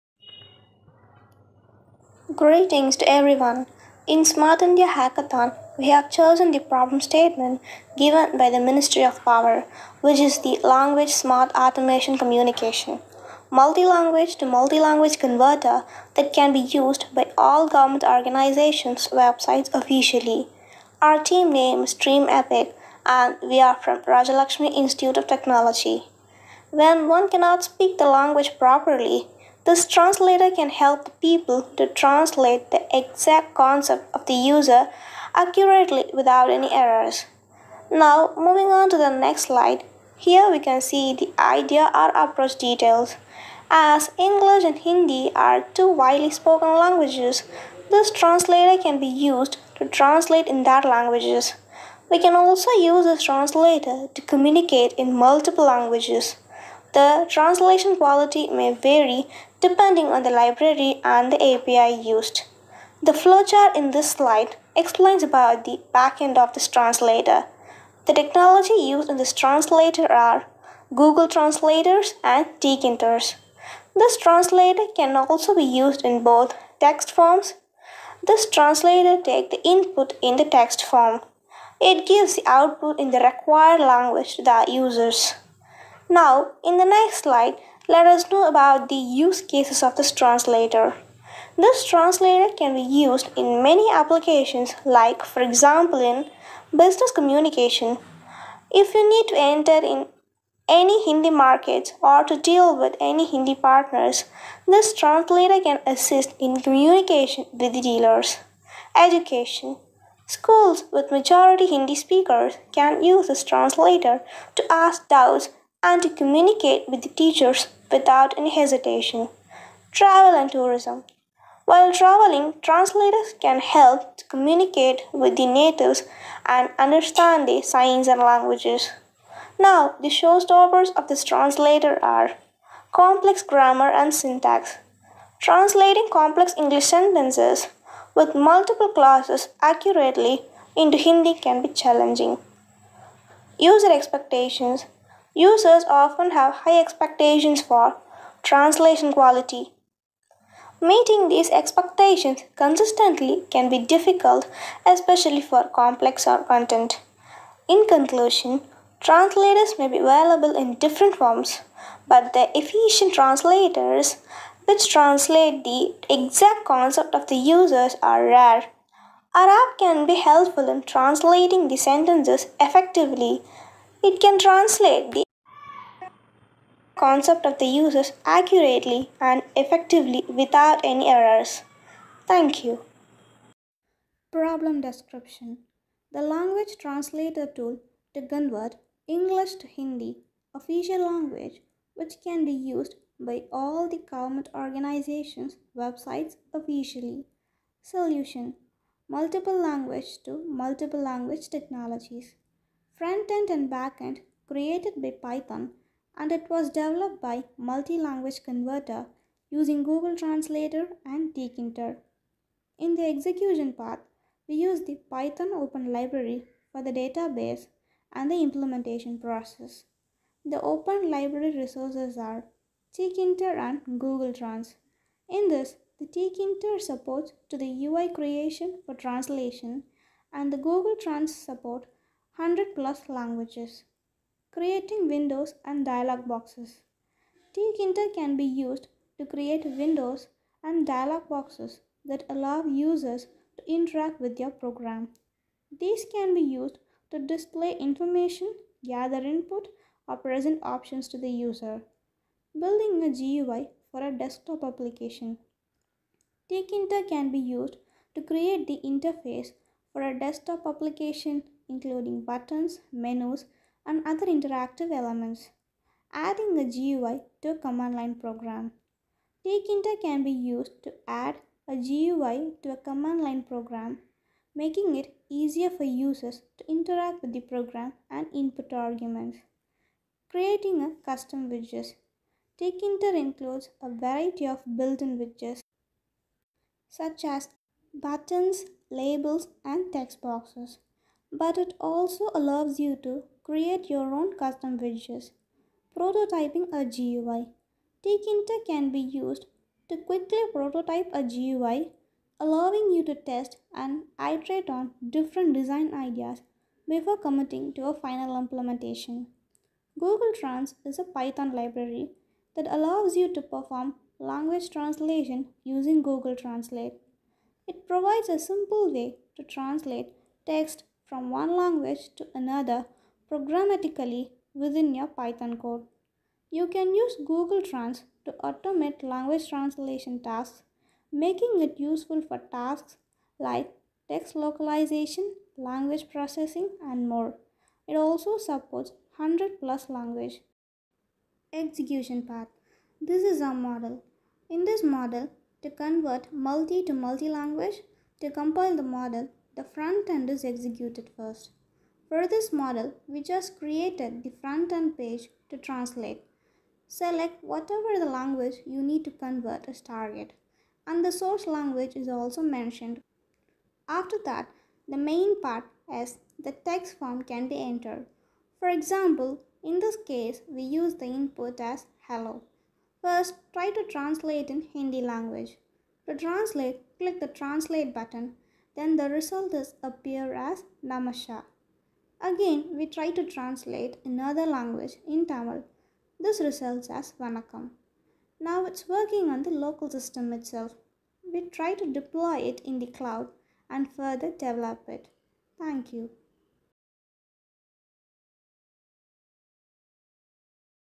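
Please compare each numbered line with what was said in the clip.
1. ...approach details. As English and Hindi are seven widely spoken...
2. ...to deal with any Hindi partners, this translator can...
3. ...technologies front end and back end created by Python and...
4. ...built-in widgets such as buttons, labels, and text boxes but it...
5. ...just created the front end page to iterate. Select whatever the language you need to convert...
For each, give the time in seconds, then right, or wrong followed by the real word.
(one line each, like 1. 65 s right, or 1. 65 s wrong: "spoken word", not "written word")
1. 42 s wrong: "two", not "seven"
2. 102 s right
3. 201 s right
4. 284 s right
5. 353 s wrong: "translate", not "iterate".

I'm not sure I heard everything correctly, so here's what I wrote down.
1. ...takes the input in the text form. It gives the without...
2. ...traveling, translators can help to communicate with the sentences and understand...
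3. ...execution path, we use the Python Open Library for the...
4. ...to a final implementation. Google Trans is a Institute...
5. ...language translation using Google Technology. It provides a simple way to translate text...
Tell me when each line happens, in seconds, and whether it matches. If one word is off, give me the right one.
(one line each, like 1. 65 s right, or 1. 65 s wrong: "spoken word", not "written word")
1. 79 s wrong: "output", not "without"
2. 121 s wrong: "natives", not "sentences"
3. 213 s right
4. 307 s wrong: "Python", not "Institute"
5. 314 s wrong: "Translate", not "Technology".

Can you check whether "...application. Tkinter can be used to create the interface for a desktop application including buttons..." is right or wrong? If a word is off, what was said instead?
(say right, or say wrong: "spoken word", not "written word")
right.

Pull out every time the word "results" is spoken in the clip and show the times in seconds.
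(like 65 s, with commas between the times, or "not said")
379 s, 386 s.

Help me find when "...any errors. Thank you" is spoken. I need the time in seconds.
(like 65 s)
180 s.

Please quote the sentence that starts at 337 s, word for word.
It also supports 100 plus language.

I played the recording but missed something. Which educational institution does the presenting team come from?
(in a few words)
Rajalakshmi Institute of Technology.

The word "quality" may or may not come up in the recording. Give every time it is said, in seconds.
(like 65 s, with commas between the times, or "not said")
57 s, 149 s.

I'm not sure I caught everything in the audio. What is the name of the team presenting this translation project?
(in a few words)
Dream Epic.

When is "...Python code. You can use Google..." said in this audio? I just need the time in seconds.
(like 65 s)
325 s.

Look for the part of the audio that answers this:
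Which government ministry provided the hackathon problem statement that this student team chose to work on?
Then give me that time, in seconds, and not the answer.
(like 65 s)
8 s.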